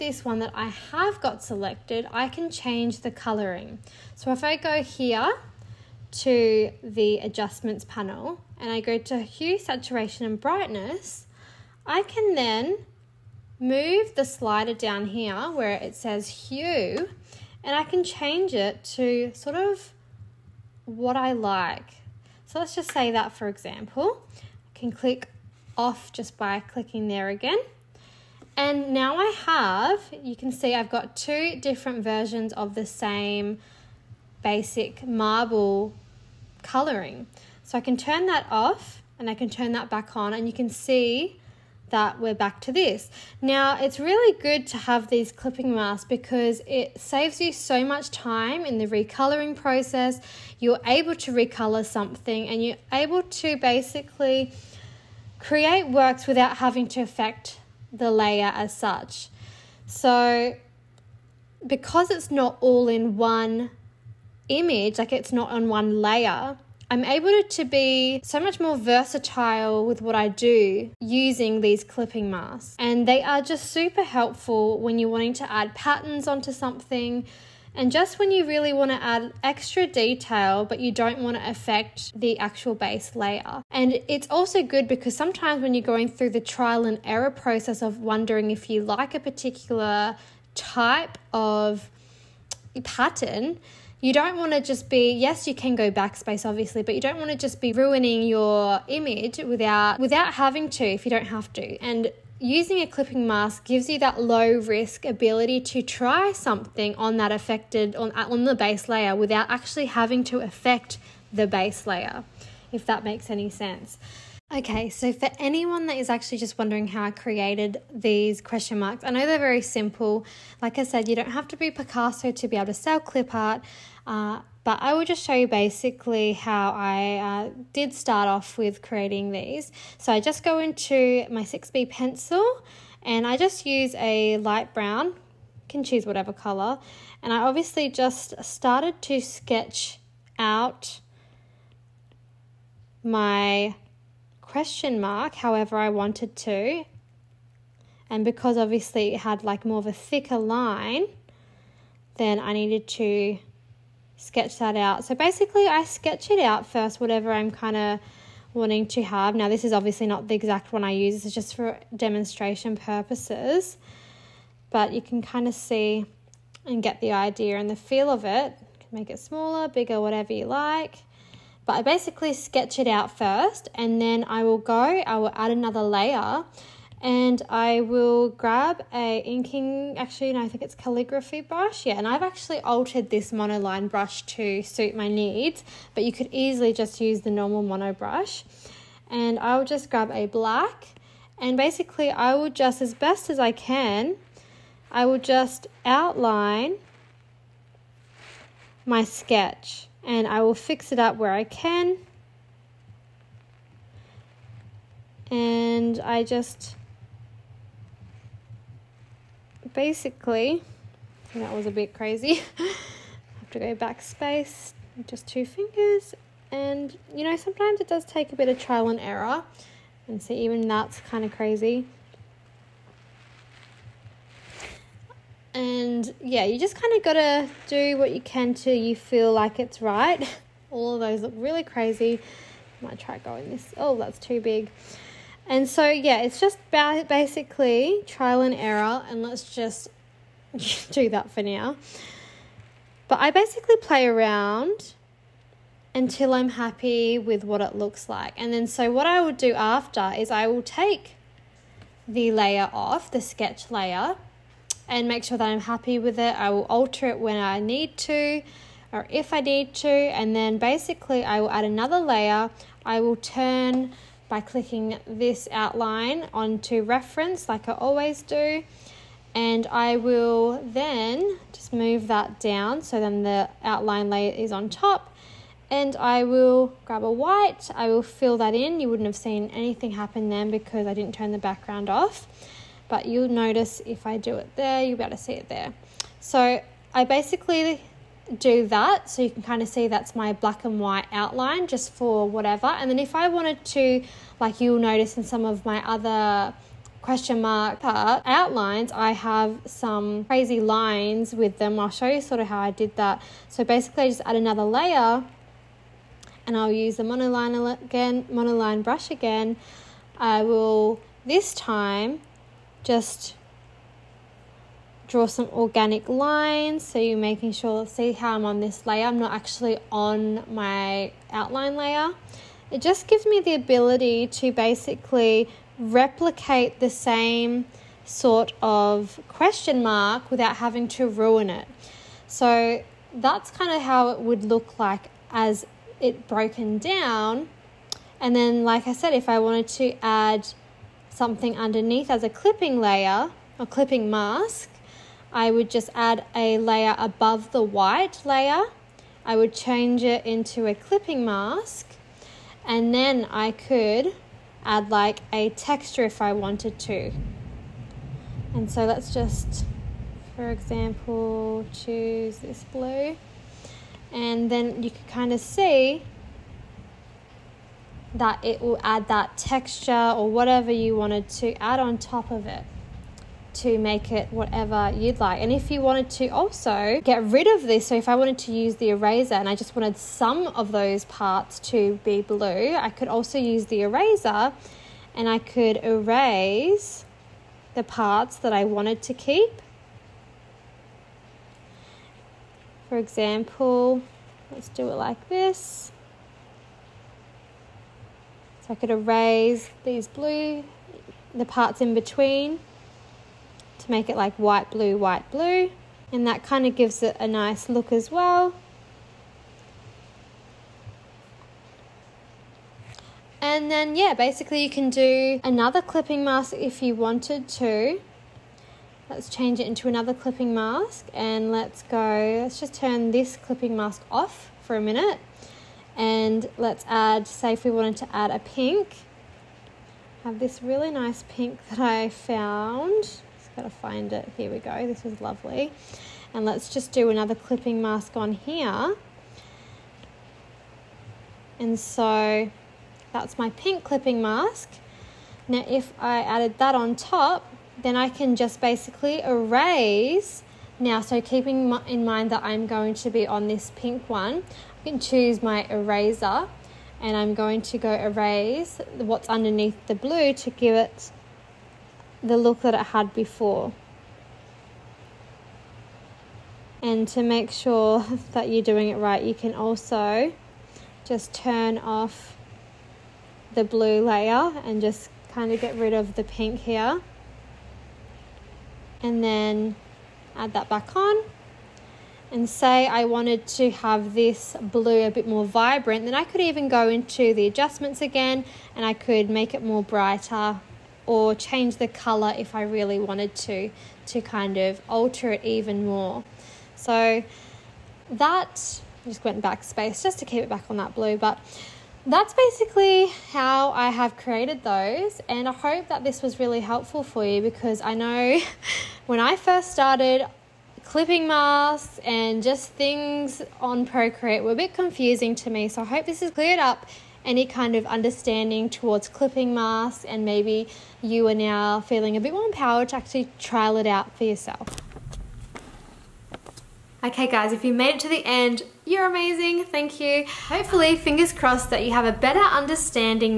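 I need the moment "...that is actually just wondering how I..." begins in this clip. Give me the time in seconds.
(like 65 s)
115 s.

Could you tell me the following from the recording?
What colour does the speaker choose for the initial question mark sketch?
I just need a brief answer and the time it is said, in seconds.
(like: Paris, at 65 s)
Light brown, at 134 s.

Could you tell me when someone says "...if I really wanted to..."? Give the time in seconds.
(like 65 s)
492 s.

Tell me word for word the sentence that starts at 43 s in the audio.
Now, it's really good to have these clipping masks because it saves you so much time in the recoloring process.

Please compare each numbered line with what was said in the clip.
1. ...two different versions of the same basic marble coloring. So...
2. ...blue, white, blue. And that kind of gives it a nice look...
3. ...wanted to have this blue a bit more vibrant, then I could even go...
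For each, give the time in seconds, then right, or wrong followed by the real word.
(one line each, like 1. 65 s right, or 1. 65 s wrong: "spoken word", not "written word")
1. 31 s right
2. 404 s right
3. 483 s right.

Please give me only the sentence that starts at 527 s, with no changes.
Okay guys, if you made it to the end, you're amazing, thank you.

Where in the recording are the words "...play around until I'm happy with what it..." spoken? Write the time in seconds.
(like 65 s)
243 s.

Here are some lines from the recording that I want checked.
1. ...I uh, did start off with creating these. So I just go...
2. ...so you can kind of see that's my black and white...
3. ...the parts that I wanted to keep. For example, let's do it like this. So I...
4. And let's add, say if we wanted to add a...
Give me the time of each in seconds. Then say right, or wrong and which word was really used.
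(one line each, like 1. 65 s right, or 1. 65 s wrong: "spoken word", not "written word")
1. 126 s right
2. 289 s right
3. 387 s right
4. 425 s right.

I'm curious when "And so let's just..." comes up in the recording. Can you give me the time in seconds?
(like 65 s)
358 s.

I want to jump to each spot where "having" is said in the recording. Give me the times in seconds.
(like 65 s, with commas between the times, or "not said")
56 s, 100 s, 109 s, 330 s.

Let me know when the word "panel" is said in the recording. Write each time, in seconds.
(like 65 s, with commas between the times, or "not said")
7 s.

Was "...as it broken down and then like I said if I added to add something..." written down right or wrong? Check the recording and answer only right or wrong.
wrong.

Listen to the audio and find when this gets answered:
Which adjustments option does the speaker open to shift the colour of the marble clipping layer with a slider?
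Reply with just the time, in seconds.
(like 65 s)
9 s.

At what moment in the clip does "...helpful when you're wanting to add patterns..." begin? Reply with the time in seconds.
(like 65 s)
74 s.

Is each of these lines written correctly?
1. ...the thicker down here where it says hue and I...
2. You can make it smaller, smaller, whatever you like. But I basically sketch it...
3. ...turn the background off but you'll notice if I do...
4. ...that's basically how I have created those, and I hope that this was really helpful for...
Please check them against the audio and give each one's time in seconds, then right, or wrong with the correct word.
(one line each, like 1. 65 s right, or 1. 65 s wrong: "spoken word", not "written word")
1. 14 s wrong: "slider", not "thicker"
2. 168 s wrong: "bigger", not "smaller"
3. 281 s right
4. 502 s right.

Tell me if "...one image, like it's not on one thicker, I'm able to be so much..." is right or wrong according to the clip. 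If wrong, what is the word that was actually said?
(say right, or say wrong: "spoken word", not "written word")
wrong: "layer", not "thicker".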